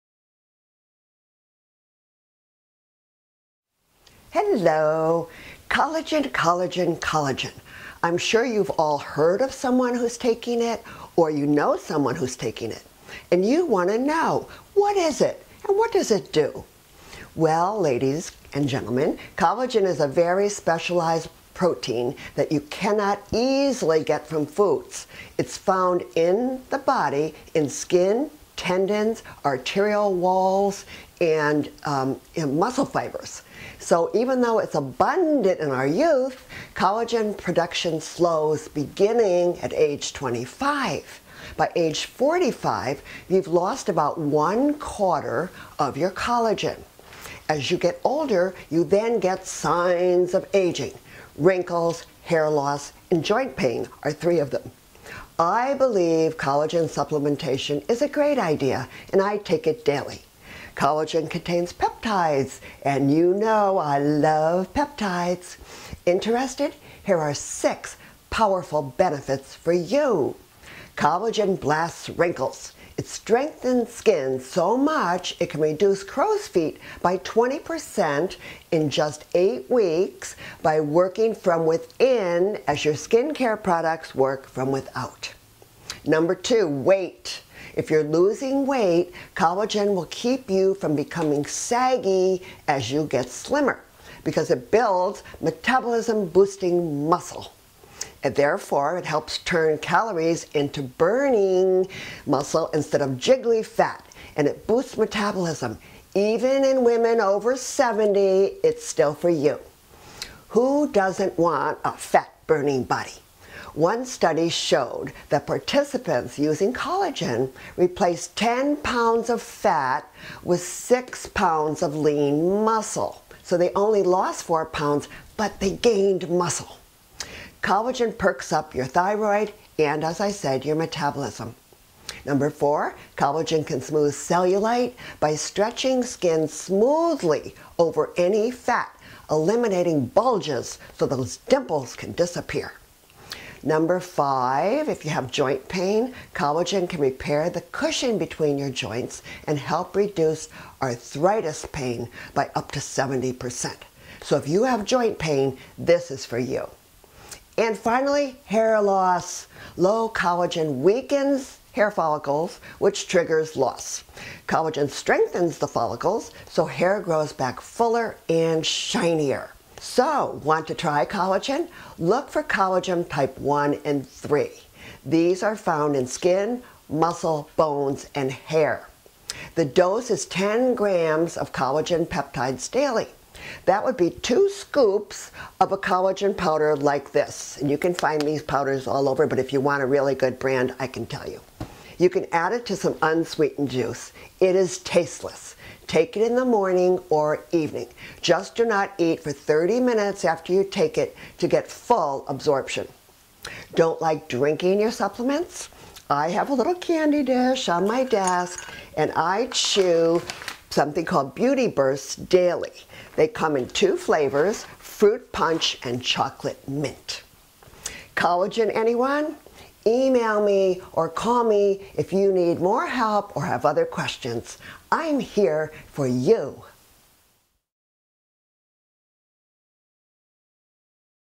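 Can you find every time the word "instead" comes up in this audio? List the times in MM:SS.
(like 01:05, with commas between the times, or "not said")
01:42.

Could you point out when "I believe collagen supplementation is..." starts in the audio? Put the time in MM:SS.
00:55.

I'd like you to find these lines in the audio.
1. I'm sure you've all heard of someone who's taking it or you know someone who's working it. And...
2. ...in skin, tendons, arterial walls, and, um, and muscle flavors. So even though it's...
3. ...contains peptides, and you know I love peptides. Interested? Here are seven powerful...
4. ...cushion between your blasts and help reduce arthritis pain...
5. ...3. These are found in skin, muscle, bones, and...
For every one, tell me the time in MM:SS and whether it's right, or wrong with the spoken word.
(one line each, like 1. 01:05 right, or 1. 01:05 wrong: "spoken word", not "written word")
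1. 00:08 wrong: "taking", not "working"
2. 00:27 wrong: "fibers", not "flavors"
3. 01:01 wrong: "six", not "seven"
4. 02:27 wrong: "joints", not "blasts"
5. 02:54 right.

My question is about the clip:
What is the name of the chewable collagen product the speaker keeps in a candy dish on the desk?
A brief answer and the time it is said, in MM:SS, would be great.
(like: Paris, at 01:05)
Beauty Bursts Daily, at 03:31.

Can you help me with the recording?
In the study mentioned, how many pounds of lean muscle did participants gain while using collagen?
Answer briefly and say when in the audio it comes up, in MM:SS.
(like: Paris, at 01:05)
6 pounds, at 02:00.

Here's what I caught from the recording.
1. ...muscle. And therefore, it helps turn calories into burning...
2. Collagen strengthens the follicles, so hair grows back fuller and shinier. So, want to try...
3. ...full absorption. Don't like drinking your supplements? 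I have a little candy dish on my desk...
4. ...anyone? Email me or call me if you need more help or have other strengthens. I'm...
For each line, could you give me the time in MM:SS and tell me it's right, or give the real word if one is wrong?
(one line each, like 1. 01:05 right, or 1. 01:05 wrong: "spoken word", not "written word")
1. 01:37 right
2. 02:44 right
3. 03:21 right
4. 03:38 wrong: "questions", not "strengthens".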